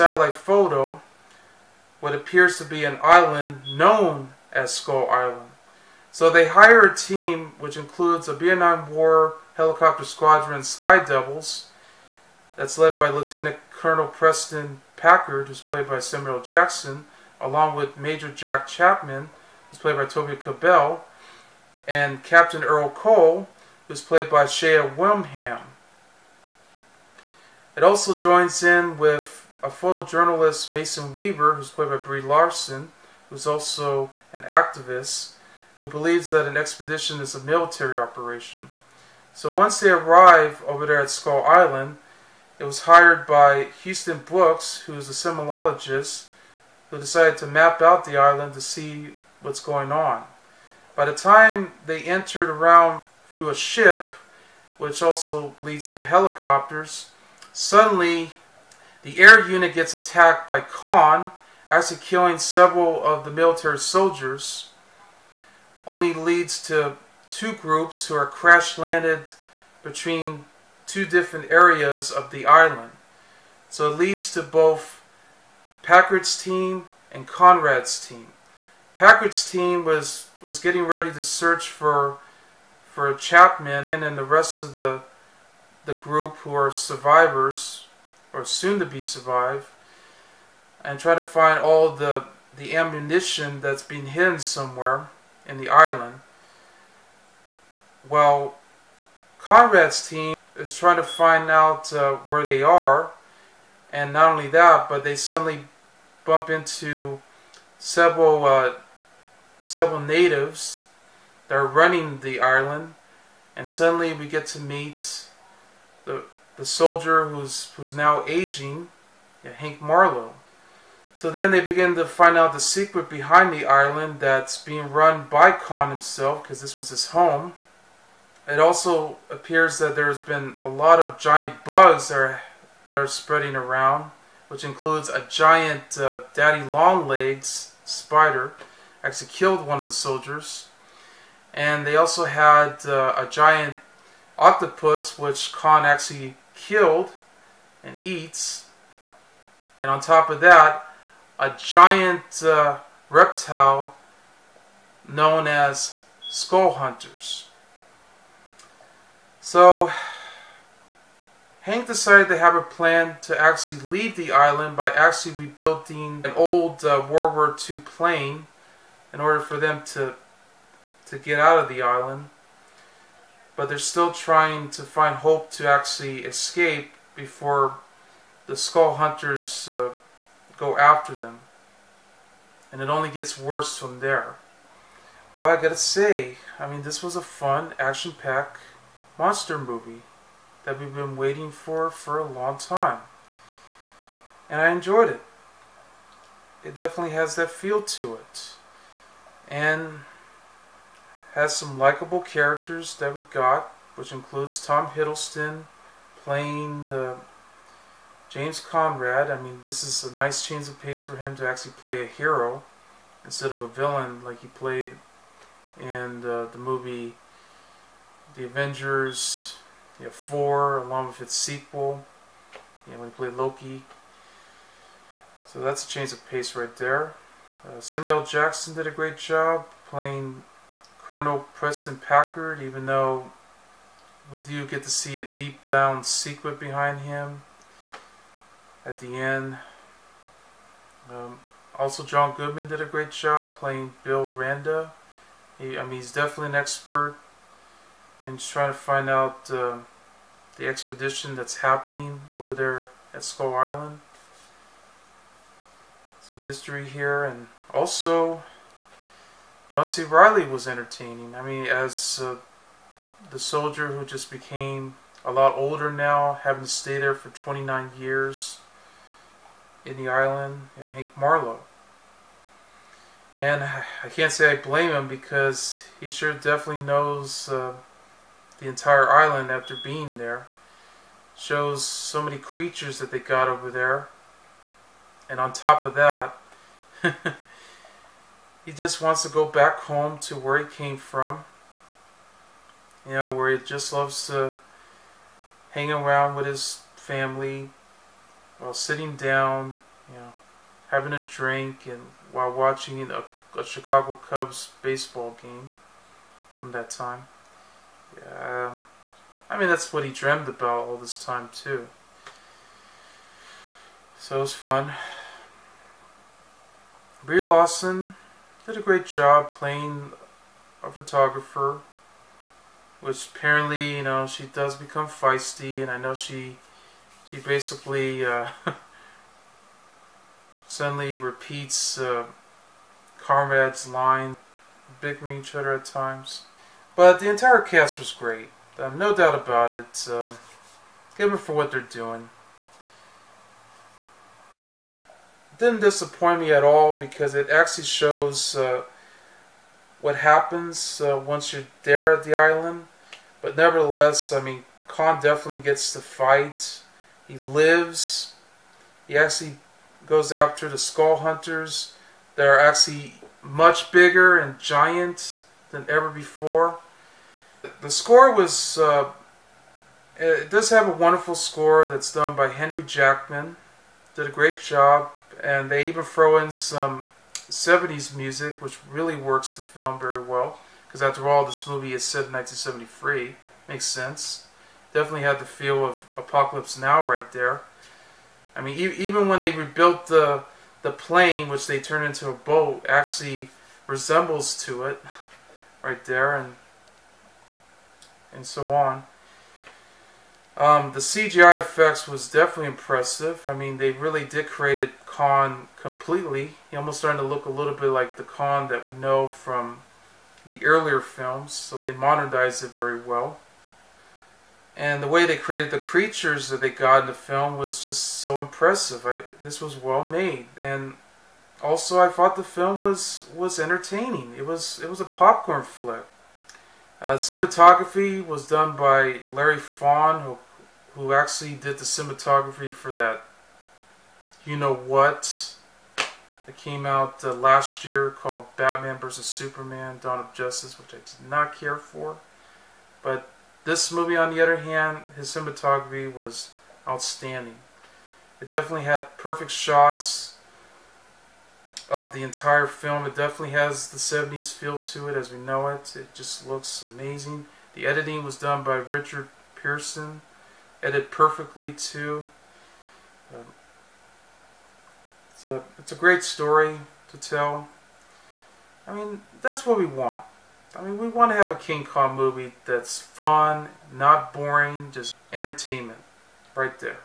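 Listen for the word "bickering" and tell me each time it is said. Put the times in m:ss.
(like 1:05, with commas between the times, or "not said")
5:35.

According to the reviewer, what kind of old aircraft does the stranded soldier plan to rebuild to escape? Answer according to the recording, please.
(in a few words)
World War II plane.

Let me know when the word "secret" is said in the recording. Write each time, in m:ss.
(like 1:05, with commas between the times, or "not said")
2:02, 3:56.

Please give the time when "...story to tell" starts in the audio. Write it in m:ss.
7:46.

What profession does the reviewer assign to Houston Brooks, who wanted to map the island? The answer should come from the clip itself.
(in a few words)
Seismologist.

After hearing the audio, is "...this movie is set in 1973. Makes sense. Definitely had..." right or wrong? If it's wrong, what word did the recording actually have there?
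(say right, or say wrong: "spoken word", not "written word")
right.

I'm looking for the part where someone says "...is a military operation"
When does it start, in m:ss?
0:37.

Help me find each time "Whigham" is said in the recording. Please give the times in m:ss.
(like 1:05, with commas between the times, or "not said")
0:24.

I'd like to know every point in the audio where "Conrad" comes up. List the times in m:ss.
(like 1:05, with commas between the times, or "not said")
1:17, 1:39, 3:28, 5:33.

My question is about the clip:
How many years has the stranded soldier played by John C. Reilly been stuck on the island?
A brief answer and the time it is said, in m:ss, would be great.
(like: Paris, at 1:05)
29, at 4:27.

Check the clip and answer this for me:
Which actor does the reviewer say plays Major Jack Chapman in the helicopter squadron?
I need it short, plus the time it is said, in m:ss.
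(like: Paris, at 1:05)
Toby Kebbell, at 0:20.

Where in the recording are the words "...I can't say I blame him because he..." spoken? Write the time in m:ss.
4:33.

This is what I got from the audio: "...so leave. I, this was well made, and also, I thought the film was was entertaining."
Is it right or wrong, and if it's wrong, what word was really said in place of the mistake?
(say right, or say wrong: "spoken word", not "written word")
wrong: "impressive", not "leave".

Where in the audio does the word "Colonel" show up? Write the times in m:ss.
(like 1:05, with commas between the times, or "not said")
0:13, 3:50.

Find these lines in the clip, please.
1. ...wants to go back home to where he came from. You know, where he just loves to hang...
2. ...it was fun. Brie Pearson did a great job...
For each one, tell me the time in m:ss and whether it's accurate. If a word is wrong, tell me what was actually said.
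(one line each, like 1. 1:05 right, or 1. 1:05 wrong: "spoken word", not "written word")
1. 4:49 right
2. 5:14 wrong: "Larson", not "Pearson".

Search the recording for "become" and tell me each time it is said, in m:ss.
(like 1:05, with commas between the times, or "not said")
5:24.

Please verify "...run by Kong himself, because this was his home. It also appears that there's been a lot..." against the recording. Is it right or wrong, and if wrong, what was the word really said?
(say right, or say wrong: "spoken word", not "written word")
right.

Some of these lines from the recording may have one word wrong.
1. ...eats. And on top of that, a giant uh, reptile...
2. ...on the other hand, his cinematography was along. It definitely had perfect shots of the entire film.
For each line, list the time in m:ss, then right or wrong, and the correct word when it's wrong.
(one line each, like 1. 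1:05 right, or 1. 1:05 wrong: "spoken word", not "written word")
1. 2:28 right
2. 7:24 wrong: "outstanding", not "along".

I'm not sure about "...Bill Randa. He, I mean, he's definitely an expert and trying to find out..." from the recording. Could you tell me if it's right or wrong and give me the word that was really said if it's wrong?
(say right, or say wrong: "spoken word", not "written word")
right.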